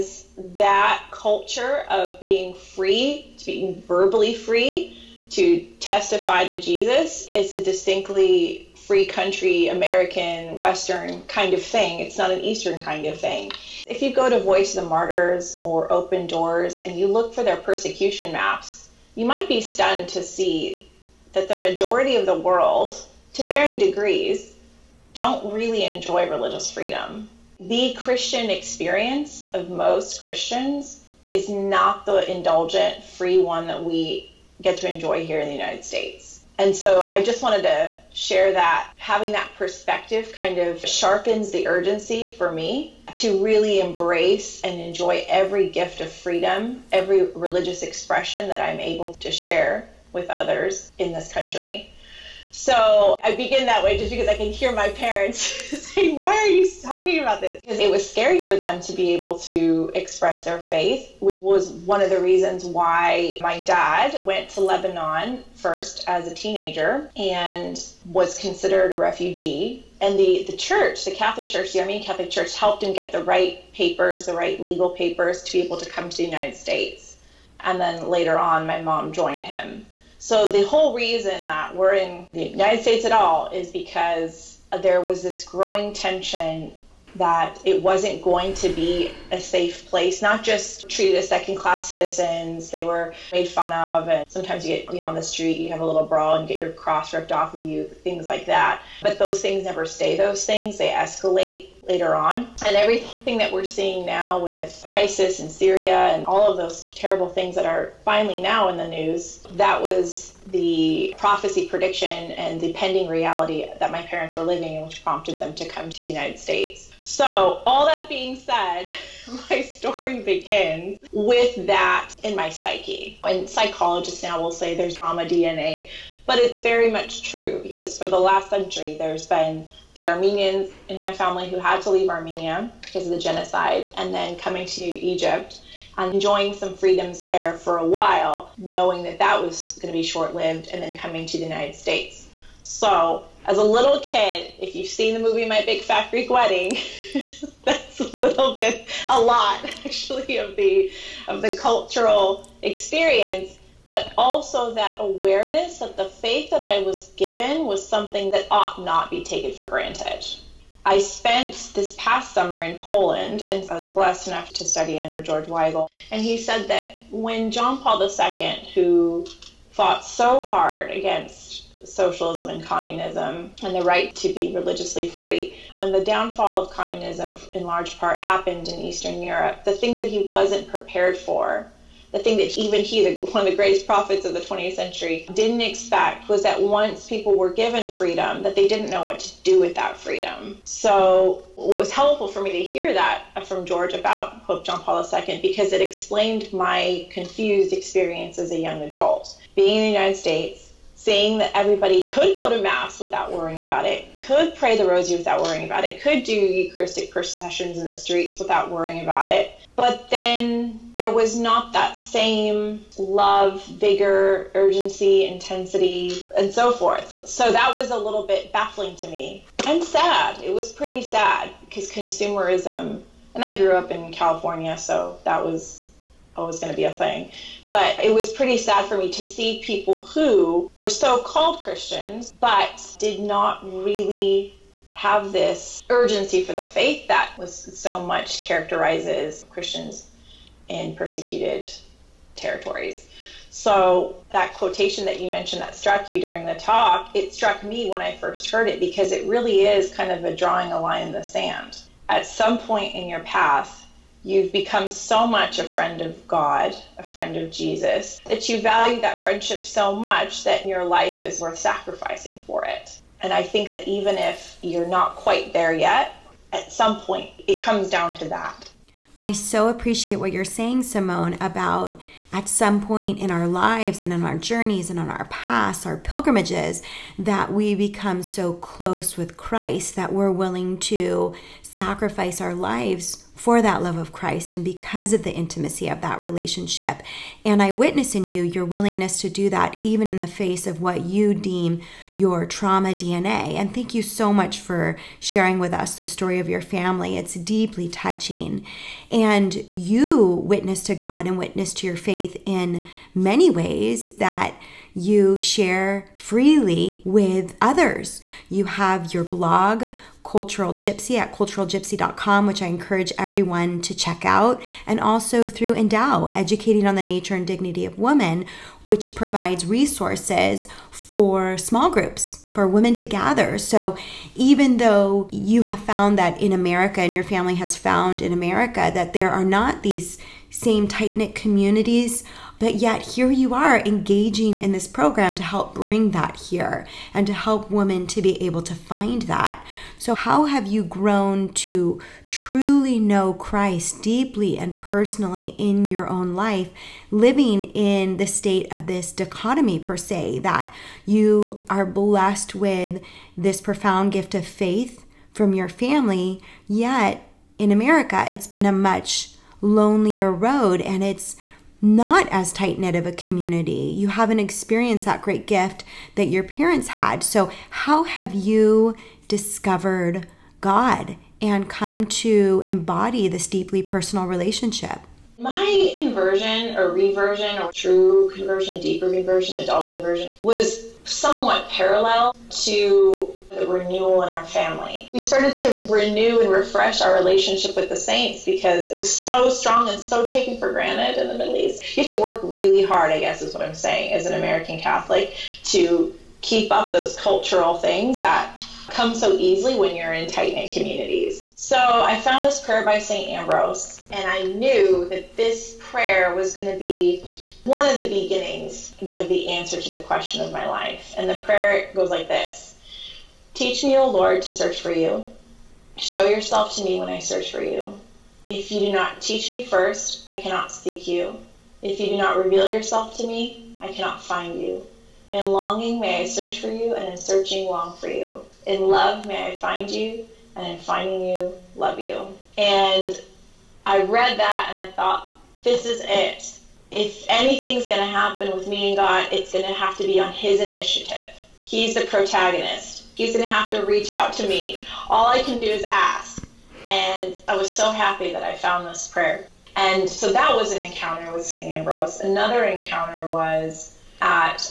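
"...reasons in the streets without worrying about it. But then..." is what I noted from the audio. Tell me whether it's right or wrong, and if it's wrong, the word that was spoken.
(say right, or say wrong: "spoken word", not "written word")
wrong: "processions", not "reasons".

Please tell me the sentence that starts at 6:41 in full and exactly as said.
So I found this prayer by St.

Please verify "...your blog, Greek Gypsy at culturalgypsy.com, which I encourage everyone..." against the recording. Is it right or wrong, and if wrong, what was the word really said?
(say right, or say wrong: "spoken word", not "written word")
wrong: "Cultural", not "Greek".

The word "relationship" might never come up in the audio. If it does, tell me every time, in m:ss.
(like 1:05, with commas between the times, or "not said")
4:46, 6:14, 6:27.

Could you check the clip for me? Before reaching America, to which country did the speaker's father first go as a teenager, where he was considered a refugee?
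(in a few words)
Lebanon.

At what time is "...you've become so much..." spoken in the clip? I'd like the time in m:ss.
4:14.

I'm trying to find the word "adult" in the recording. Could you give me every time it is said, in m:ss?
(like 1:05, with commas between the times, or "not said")
3:18, 6:19.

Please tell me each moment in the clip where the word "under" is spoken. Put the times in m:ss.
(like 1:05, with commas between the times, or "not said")
2:44.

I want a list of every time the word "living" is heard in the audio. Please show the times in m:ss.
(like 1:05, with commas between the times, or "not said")
1:54, 5:47.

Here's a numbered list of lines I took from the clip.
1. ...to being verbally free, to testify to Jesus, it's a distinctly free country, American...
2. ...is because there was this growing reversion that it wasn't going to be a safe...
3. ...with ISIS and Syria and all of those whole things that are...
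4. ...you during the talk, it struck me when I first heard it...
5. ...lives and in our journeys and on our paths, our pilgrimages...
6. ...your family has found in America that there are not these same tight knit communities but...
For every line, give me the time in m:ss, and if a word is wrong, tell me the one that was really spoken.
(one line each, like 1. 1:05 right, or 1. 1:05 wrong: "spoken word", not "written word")
1. 0:03 right
2. 1:23 wrong: "tension", not "reversion"
3. 1:44 wrong: "terrible", not "whole"
4. 4:06 right
5. 4:33 right
6. 5:27 right.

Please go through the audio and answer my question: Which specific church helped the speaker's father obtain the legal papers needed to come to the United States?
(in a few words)
Armenian Catholic Church.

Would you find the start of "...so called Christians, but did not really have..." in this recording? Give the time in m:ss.
3:50.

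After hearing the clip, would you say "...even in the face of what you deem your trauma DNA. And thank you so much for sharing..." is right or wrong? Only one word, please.
right.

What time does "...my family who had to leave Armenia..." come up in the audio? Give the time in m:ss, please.
2:10.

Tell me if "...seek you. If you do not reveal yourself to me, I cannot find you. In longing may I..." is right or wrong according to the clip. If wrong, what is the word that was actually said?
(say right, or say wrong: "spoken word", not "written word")
right.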